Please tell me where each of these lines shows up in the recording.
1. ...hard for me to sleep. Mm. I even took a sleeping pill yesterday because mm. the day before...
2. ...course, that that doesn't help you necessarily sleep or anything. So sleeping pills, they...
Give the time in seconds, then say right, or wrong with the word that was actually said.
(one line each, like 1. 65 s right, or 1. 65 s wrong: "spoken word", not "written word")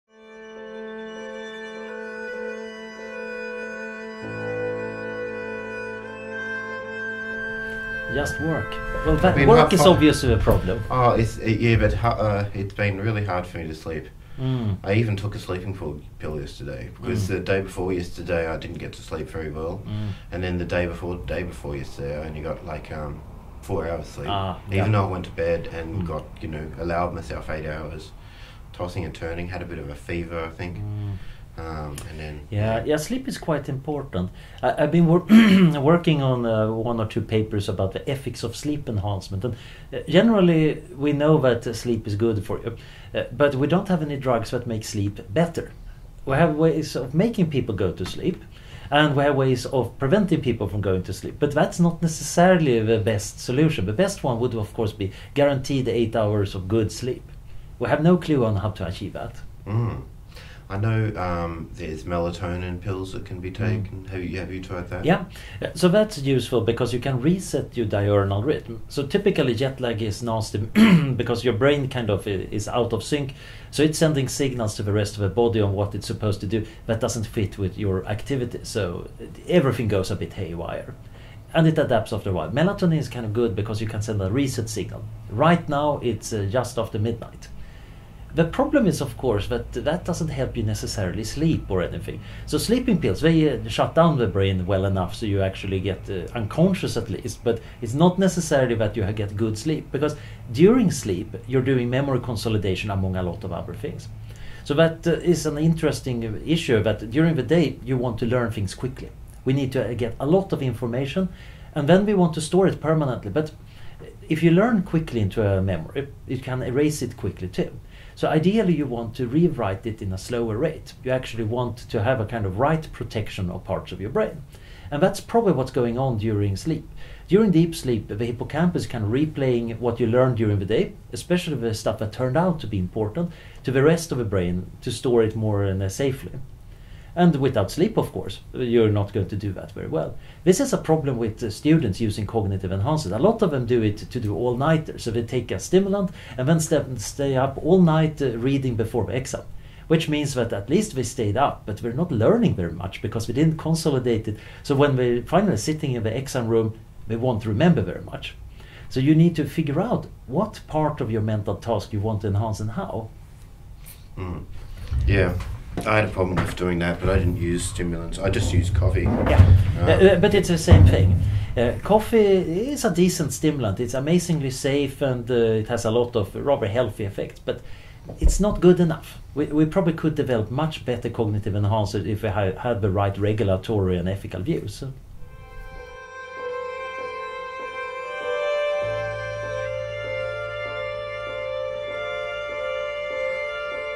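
1. 13 s right
2. 89 s right.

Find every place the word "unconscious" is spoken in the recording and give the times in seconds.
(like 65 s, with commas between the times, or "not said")
96 s.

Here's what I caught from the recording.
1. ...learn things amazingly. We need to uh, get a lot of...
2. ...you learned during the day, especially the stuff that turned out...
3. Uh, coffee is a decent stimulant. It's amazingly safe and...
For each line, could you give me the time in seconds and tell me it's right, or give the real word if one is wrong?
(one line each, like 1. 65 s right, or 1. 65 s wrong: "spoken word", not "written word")
1. 108 s wrong: "quickly", not "amazingly"
2. 130 s right
3. 171 s right.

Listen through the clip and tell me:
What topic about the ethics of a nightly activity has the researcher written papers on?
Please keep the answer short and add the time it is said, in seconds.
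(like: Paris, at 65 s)
sleep enhancement, at 38 s.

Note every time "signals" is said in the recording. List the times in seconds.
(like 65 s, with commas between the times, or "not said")
74 s, 84 s.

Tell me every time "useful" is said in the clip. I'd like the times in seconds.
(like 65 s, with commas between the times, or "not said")
66 s.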